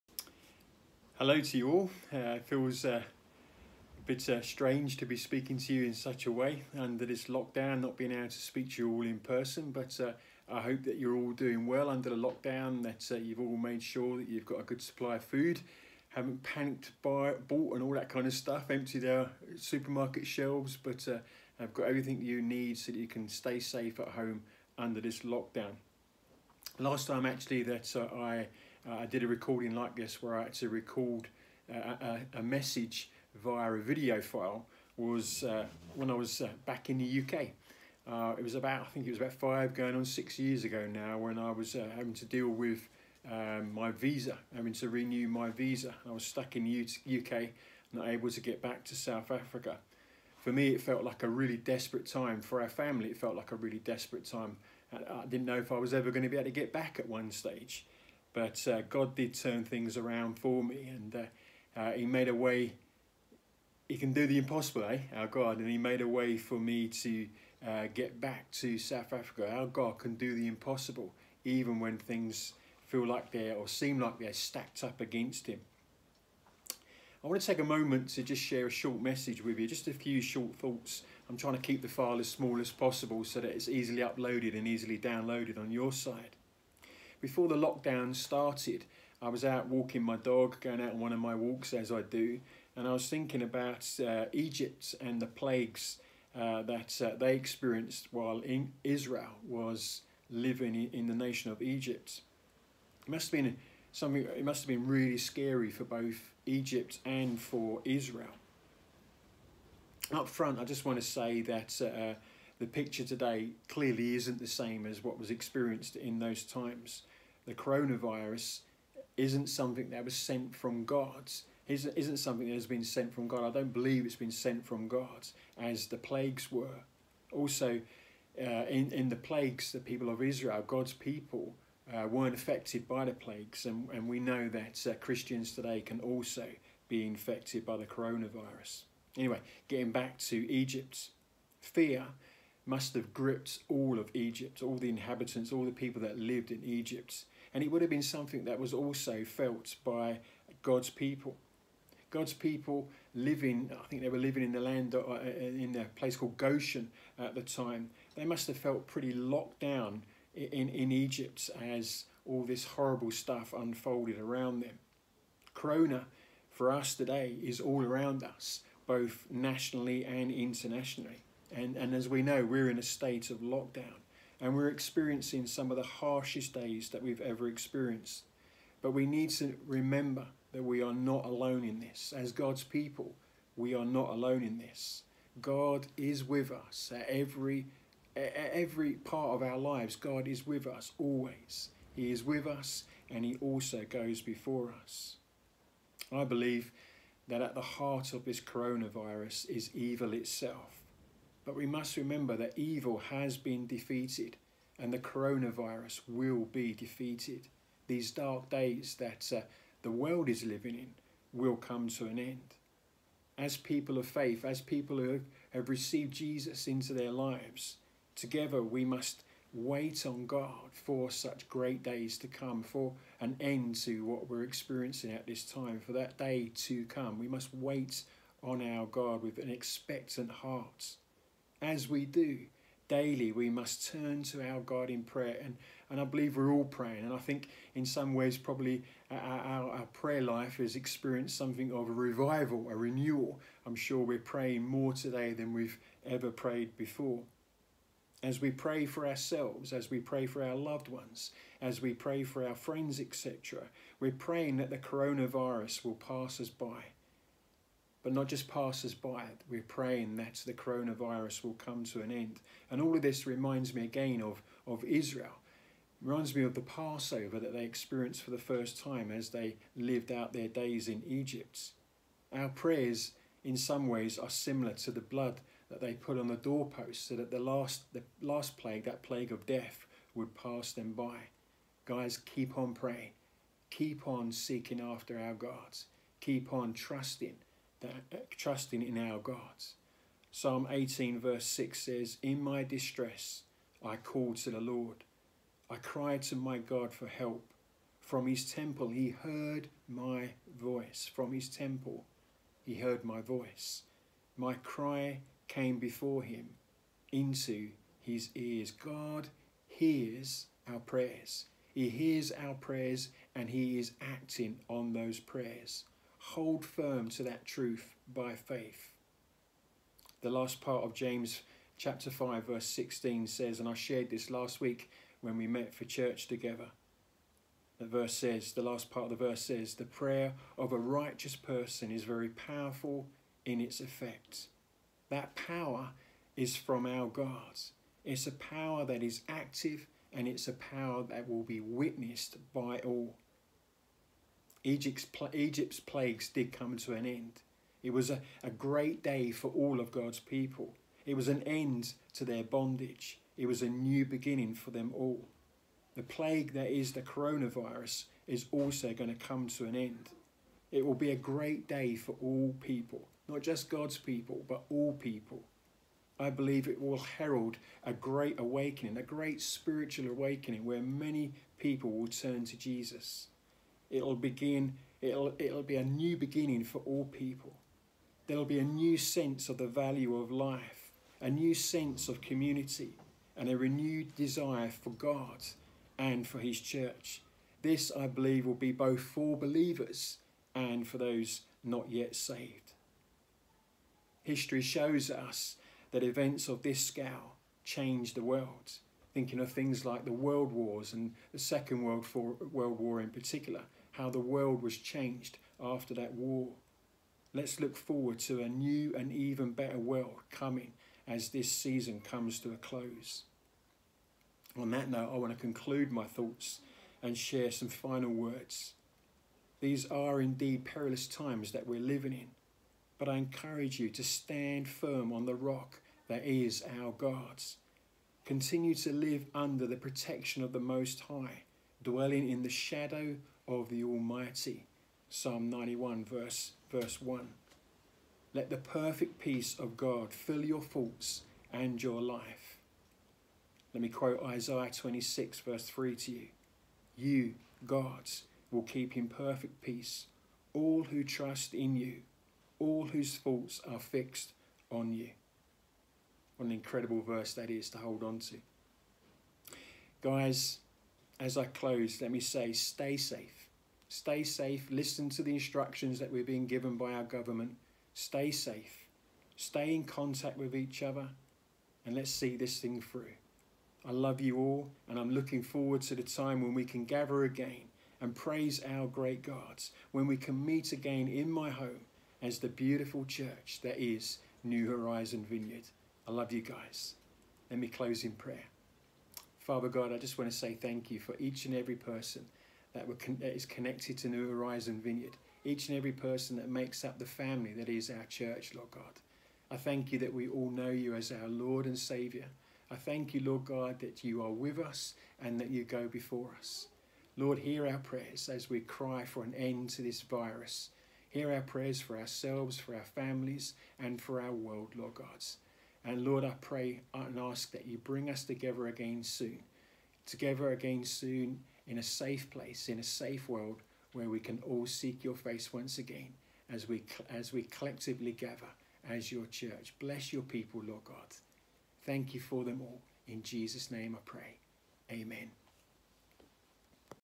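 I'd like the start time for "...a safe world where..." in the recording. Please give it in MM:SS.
08:42.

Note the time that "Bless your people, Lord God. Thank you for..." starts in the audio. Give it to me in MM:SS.
08:49.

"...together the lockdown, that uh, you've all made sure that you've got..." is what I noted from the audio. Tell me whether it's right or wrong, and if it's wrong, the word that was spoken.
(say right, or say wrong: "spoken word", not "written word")
wrong: "under", not "together".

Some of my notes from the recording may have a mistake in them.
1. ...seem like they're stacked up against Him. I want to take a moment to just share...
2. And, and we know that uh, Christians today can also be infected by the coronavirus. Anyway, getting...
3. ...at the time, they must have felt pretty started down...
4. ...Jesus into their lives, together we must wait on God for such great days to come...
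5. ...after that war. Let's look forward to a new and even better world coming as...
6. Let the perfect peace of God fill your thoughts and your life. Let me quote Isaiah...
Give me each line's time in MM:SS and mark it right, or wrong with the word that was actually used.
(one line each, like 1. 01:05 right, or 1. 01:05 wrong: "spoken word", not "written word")
1. 01:13 right
2. 02:13 right
3. 02:37 wrong: "locked", not "started"
4. 03:36 right
5. 06:45 right
6. 07:18 right.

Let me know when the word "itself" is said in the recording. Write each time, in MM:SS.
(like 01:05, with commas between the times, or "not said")
03:20.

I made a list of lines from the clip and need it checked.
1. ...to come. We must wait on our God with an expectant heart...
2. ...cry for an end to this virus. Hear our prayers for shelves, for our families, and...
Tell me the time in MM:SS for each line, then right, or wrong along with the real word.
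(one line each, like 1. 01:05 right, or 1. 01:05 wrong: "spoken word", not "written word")
1. 03:46 right
2. 08:28 wrong: "ourselves", not "shelves".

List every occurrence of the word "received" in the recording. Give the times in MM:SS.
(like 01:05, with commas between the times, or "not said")
03:35.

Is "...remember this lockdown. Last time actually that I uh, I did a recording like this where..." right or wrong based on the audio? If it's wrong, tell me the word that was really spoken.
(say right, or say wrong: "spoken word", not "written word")
wrong: "under", not "remember".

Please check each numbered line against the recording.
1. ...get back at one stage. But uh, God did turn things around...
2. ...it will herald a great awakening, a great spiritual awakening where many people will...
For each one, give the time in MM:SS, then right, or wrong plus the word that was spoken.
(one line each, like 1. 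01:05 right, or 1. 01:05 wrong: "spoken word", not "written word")
1. 00:56 right
2. 06:06 right.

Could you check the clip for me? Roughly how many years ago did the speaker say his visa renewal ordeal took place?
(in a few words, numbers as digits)
5 going on 6 years.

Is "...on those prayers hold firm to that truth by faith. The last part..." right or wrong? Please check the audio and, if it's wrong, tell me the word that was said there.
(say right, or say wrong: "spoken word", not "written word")
right.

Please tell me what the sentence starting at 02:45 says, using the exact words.
Corona for us today is all around us, both nationally and internationally.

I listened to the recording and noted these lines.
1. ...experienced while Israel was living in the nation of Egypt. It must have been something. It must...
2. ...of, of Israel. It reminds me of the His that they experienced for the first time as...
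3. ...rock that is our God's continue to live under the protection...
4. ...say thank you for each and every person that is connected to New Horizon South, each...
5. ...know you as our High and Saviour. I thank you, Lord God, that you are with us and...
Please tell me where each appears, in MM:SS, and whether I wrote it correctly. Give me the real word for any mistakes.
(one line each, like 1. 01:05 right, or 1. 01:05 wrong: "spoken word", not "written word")
1. 01:37 right
2. 04:24 wrong: "Passover", not "His"
3. 07:05 right
4. 08:10 wrong: "Vineyard", not "South"
5. 08:20 wrong: "Lord", not "High".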